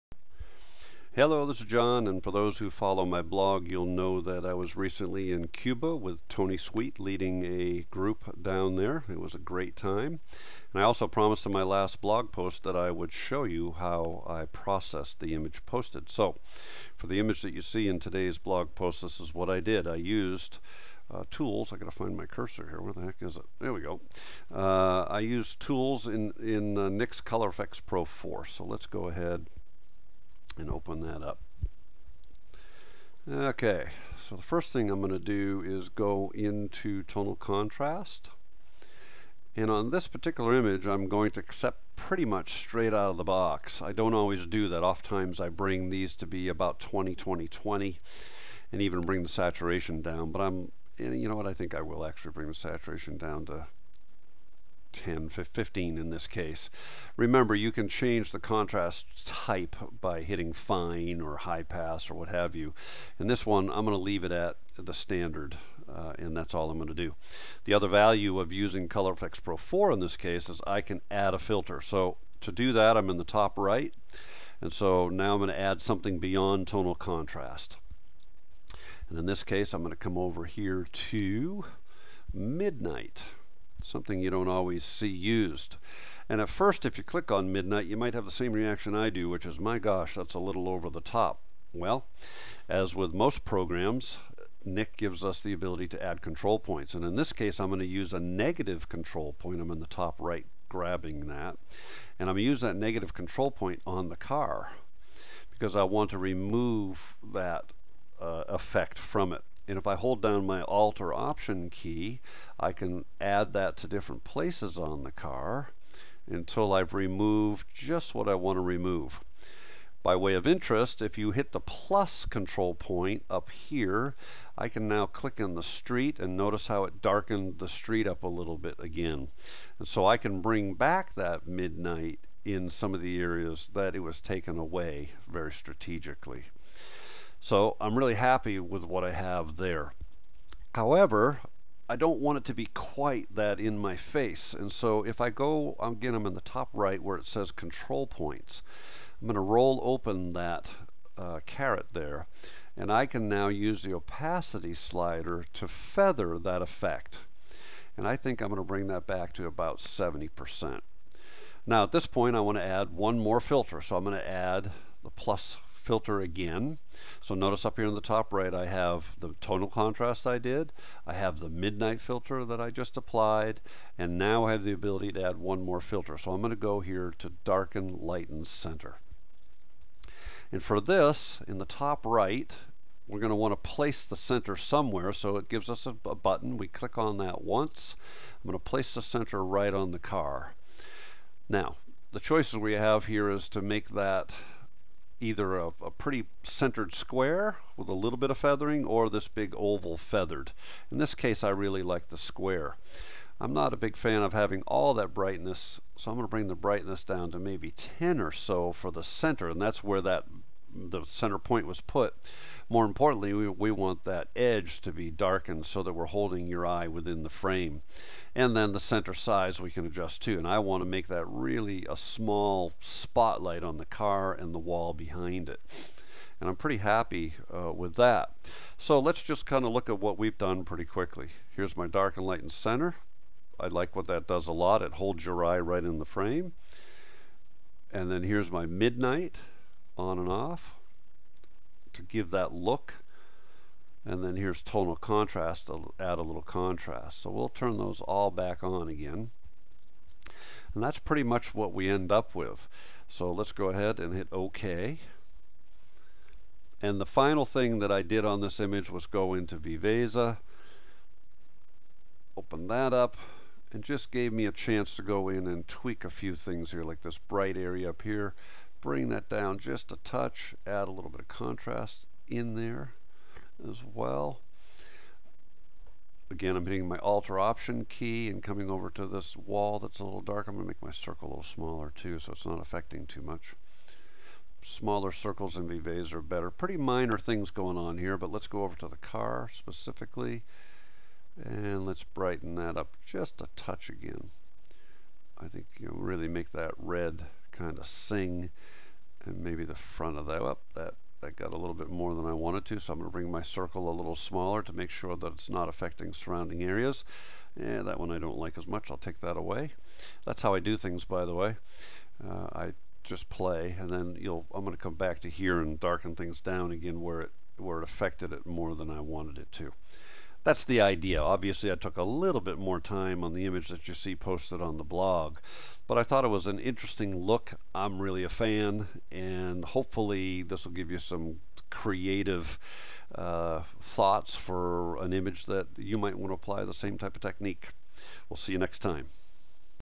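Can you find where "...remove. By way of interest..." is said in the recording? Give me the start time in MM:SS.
01:58.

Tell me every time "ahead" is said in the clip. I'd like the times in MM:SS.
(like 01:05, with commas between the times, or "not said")
00:29, 04:13.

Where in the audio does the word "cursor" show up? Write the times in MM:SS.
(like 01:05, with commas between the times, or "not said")
00:22.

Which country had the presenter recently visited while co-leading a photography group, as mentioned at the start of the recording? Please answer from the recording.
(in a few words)
Cuba.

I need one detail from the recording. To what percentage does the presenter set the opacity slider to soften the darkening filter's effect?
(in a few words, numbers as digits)
70%.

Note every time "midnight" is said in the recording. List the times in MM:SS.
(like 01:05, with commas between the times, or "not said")
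01:22, 01:27, 02:11, 02:51, 03:58.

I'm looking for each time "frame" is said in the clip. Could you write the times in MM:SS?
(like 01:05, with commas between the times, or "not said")
03:37, 03:56.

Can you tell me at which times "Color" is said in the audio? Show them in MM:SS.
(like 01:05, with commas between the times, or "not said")
00:27, 01:08.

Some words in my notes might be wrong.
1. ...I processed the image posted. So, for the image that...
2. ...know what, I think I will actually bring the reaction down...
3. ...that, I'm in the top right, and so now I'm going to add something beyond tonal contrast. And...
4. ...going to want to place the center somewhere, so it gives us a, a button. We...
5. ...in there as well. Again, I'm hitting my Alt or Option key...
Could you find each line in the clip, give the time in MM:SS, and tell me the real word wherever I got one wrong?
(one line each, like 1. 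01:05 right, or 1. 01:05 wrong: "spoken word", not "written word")
1. 00:14 right
2. 00:51 wrong: "saturation", not "reaction"
3. 01:12 right
4. 03:03 right
5. 04:32 right.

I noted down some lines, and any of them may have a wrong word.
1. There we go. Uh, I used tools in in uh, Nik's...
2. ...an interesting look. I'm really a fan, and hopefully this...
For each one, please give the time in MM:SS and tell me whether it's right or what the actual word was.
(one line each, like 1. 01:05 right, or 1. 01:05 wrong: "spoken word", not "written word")
1. 00:23 right
2. 05:26 right.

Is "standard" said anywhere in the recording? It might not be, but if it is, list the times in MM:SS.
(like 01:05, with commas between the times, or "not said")
01:04.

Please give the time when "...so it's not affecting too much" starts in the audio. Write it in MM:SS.
04:42.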